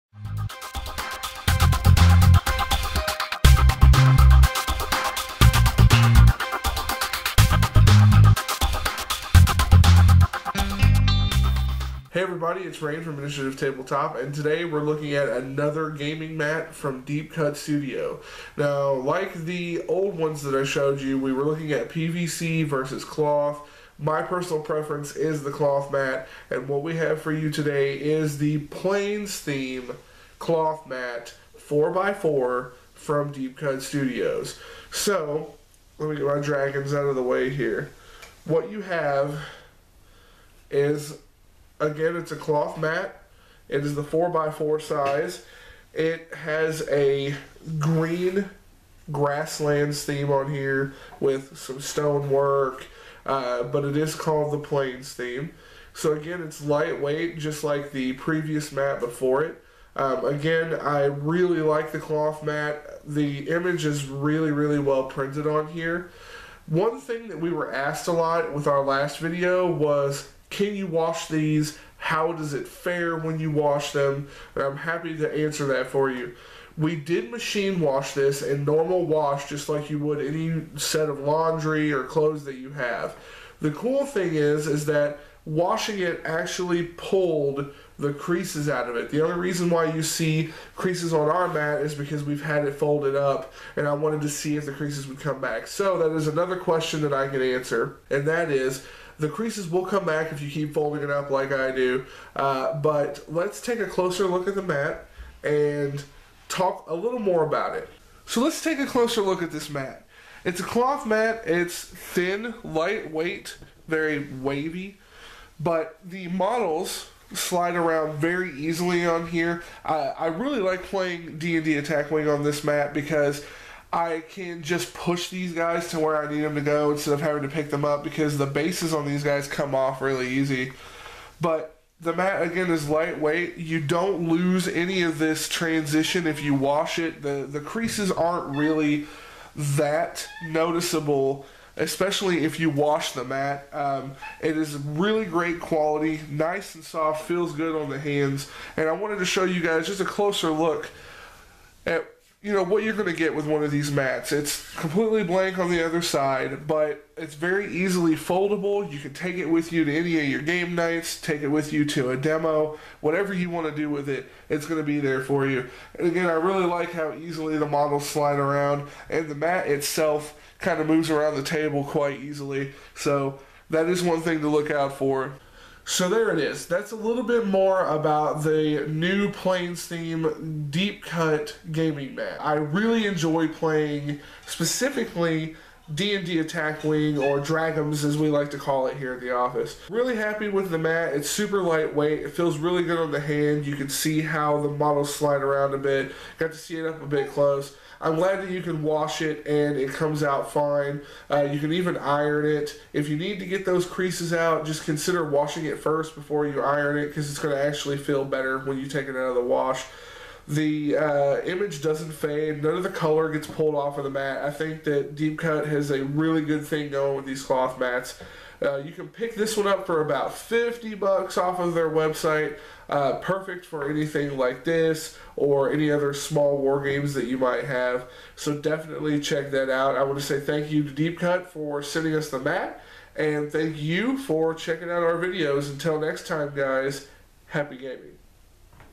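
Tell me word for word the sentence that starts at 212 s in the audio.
None of the color gets pulled off of the mat.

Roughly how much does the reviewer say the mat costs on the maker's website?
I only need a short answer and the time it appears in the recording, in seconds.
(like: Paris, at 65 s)
$50, at 220 s.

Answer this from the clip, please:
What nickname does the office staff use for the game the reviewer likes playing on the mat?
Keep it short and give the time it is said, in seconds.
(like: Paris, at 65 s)
Dragums, at 187 s.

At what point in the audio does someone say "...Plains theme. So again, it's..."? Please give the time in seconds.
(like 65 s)
54 s.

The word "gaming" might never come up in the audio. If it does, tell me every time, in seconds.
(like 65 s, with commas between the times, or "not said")
15 s, 181 s, 237 s.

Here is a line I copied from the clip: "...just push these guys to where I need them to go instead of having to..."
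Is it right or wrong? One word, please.
right.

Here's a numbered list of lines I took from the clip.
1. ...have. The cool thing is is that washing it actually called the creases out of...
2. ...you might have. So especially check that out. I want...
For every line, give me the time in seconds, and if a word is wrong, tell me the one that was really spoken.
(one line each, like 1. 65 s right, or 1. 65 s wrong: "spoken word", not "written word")
1. 82 s wrong: "pulled", not "called"
2. 227 s wrong: "definitely", not "especially".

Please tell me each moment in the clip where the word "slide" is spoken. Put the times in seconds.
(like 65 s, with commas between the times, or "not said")
117 s, 168 s, 195 s.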